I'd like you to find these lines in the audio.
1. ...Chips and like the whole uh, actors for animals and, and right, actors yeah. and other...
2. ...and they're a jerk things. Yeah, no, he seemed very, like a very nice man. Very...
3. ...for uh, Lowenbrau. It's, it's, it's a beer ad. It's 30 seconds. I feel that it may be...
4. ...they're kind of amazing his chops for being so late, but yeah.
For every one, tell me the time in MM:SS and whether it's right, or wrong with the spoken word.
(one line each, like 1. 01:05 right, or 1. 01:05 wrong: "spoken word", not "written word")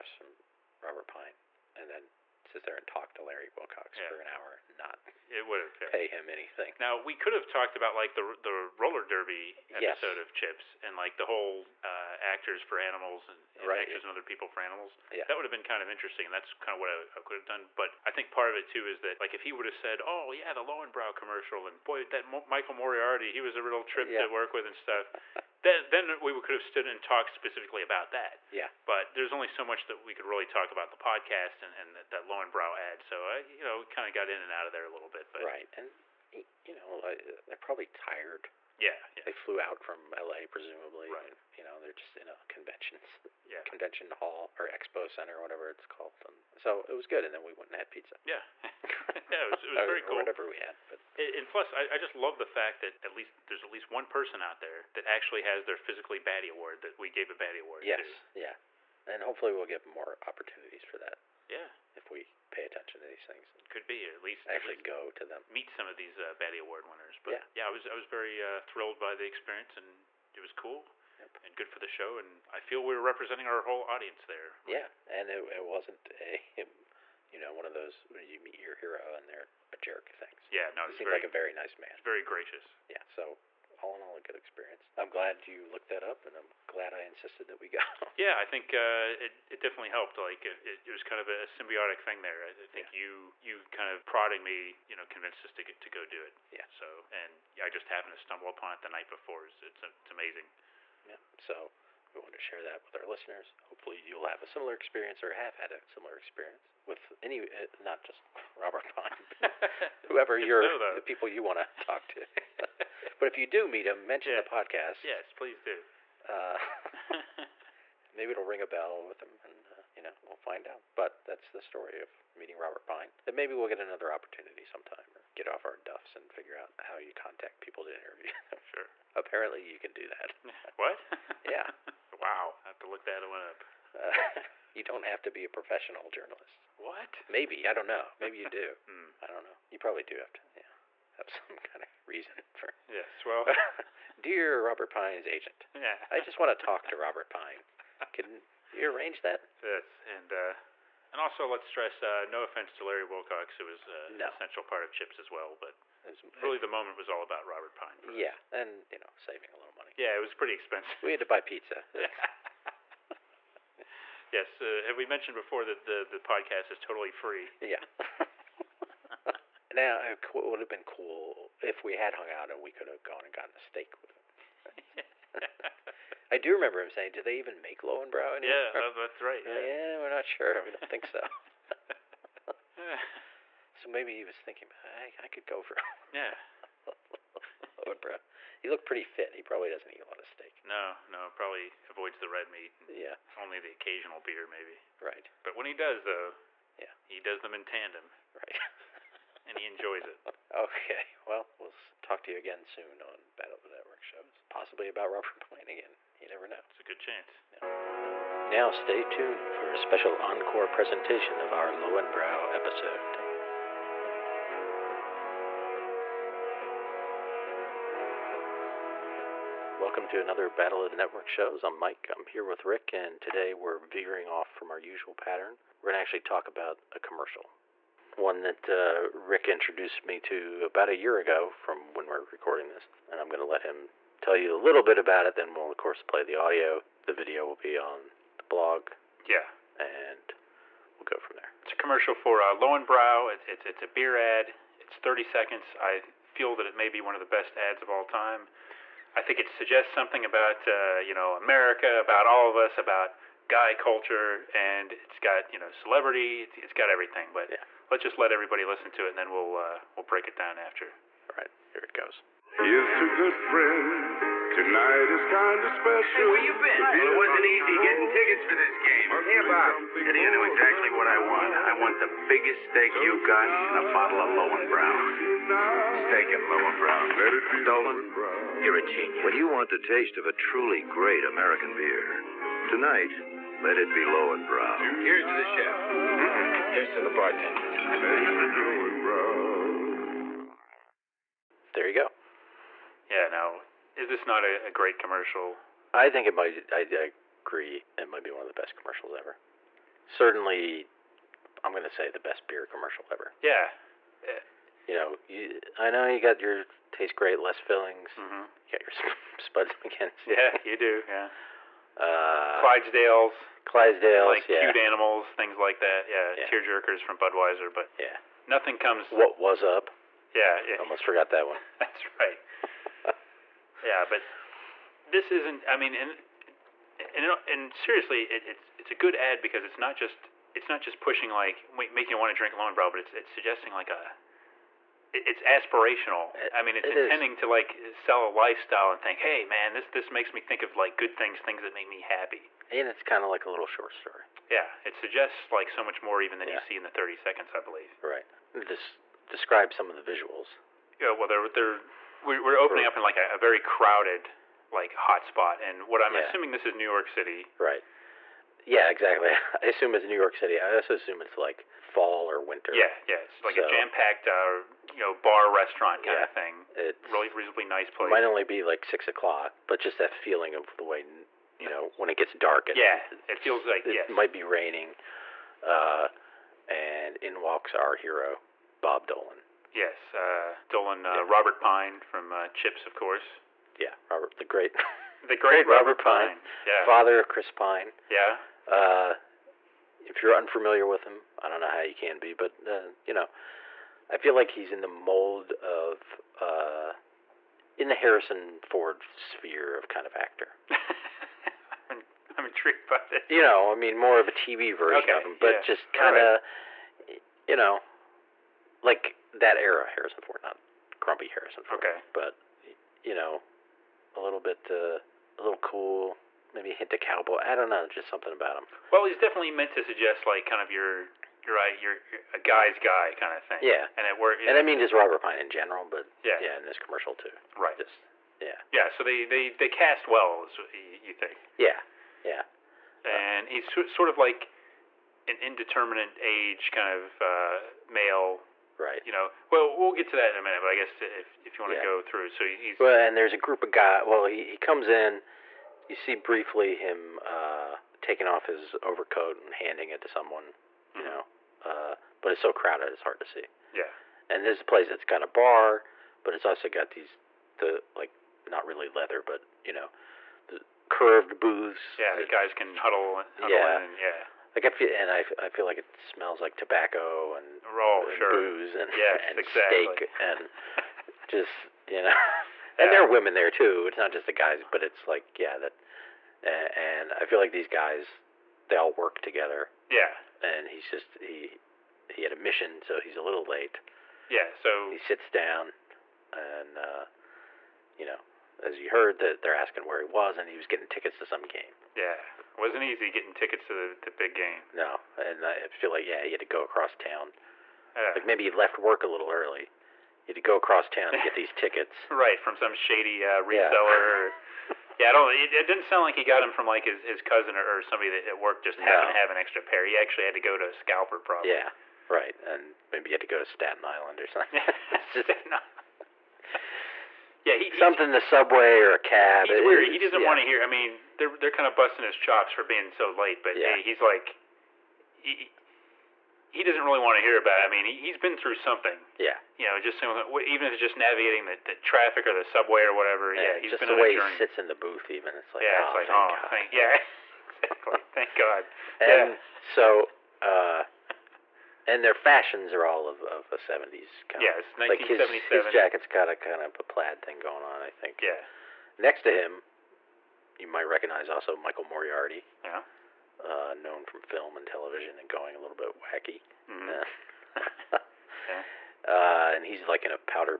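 1. 00:10 right
2. 01:19 right
3. 04:02 right
4. 08:41 wrong: "busting", not "amazing".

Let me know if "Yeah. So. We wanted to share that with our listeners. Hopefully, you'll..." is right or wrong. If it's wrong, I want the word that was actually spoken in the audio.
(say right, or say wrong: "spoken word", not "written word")
right.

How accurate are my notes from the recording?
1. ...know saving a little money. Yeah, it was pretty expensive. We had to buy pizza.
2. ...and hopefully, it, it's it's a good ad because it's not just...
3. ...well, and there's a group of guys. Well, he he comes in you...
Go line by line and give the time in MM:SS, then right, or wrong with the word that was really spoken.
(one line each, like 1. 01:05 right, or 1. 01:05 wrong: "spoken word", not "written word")
1. 02:38 right
2. 05:27 wrong: "seriously", not "hopefully"
3. 07:22 right.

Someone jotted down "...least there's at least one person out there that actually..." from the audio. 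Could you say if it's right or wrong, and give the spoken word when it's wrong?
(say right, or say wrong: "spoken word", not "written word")
right.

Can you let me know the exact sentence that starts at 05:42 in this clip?
And it's kind of like a little short story.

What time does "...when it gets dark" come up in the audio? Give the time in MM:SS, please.
06:11.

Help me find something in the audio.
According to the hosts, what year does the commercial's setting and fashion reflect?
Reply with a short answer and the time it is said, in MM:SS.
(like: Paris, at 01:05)
1977, at 09:04.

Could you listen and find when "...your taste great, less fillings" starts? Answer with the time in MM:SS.
05:06.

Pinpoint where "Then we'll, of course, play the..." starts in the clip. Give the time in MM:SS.
03:55.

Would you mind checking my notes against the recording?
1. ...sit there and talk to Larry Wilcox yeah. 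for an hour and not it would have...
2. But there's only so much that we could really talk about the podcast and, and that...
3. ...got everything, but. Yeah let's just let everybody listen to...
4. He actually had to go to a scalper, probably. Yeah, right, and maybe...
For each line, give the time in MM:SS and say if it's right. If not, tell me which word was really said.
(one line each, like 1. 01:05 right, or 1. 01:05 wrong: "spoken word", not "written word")
1. 00:02 right
2. 00:28 right
3. 04:16 right
4. 08:29 right.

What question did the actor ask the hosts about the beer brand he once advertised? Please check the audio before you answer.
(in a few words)
Do they even make Lowenbrau anymore?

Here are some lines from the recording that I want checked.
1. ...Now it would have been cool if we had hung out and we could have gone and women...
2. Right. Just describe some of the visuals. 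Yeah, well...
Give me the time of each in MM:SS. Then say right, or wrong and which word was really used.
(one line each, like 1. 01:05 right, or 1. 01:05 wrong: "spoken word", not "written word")
1. 02:49 wrong: "gotten", not "women"
2. 05:48 right.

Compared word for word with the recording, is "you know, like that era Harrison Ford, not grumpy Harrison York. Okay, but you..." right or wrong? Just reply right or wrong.
wrong.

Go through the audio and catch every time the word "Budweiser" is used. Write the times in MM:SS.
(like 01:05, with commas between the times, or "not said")
05:17.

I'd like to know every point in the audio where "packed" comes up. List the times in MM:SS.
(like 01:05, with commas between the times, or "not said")
06:03.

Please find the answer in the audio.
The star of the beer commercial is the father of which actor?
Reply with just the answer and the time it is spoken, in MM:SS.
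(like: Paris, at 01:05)
Chris Pine, at 06:27.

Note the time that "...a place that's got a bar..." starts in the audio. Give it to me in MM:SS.
07:34.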